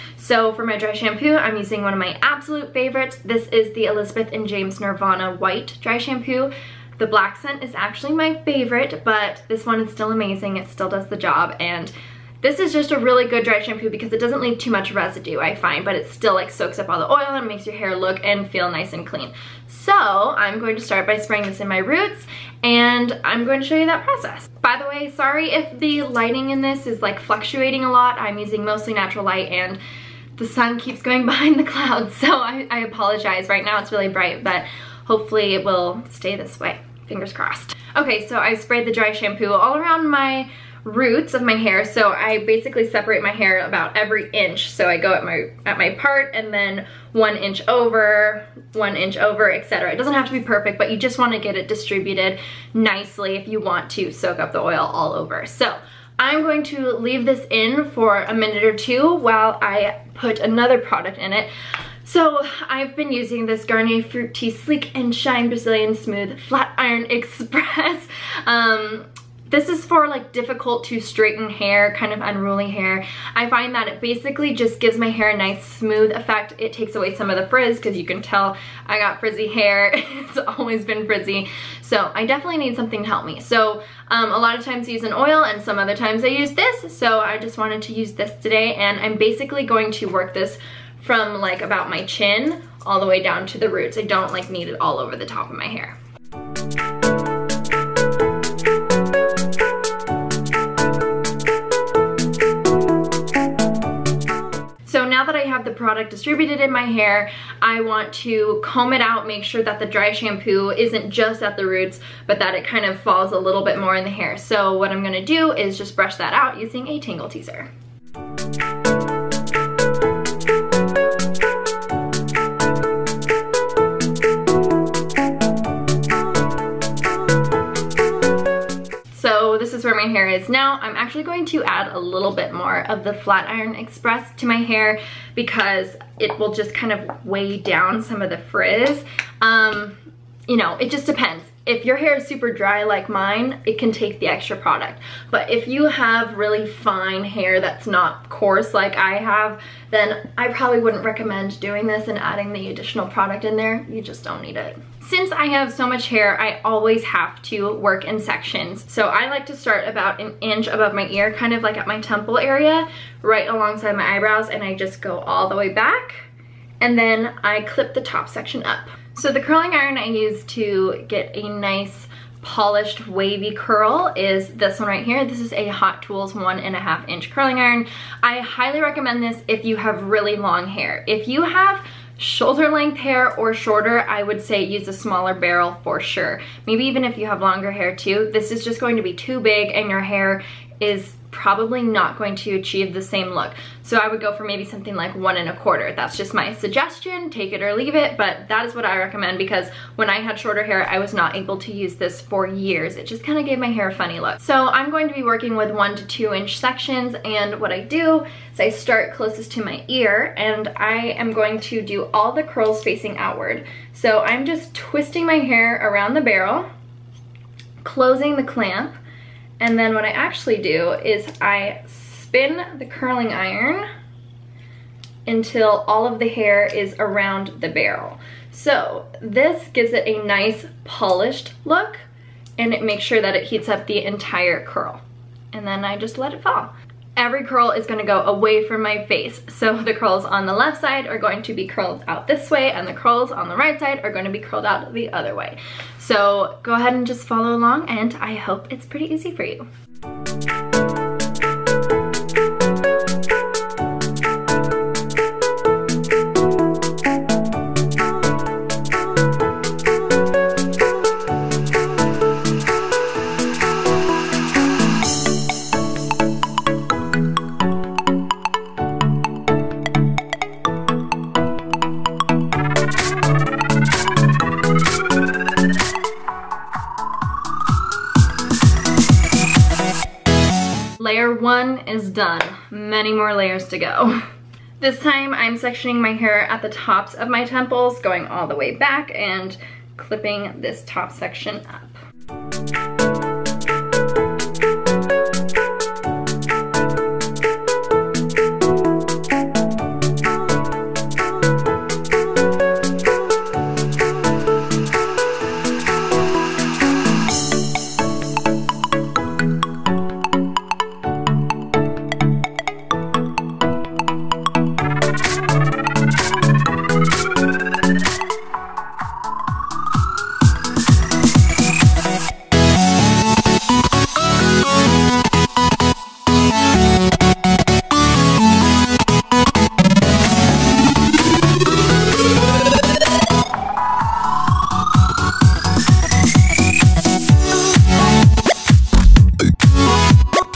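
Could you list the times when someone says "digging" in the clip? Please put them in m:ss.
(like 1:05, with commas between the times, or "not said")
not said.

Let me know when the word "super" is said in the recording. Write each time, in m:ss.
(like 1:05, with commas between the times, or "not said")
2:22.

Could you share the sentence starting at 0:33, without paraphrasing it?
Right now it's really bright, but hopefully it will stay this way.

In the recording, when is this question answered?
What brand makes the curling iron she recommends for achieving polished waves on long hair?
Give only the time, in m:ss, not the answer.
2:55.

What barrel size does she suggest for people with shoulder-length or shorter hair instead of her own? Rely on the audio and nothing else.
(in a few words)
1 and a quarter inch.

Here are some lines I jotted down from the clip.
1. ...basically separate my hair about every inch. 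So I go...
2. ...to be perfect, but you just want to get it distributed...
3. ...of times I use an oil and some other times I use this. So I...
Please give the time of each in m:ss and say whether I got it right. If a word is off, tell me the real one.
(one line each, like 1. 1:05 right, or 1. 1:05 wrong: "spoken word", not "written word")
1. 0:42 right
2. 0:50 right
3. 1:24 right.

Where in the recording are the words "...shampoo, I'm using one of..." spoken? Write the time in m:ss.
0:00.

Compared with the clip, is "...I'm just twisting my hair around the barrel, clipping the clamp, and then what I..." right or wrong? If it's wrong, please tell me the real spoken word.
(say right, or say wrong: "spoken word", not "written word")
wrong: "closing", not "clipping".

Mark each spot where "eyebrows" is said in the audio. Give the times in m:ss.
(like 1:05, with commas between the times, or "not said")
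2:44.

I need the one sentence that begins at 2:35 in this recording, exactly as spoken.
Since I have so much hair, I always have to work in sections.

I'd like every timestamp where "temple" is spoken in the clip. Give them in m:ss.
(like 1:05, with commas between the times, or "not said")
2:41, 4:47.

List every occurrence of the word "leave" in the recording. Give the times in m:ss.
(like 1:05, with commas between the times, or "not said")
0:14, 0:56, 3:17.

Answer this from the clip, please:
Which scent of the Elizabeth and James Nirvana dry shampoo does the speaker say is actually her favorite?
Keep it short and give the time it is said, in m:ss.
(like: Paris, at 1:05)
Black, at 0:07.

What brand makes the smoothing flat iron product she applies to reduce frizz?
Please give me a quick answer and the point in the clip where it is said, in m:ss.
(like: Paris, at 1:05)
Garnier Fructis, at 1:03.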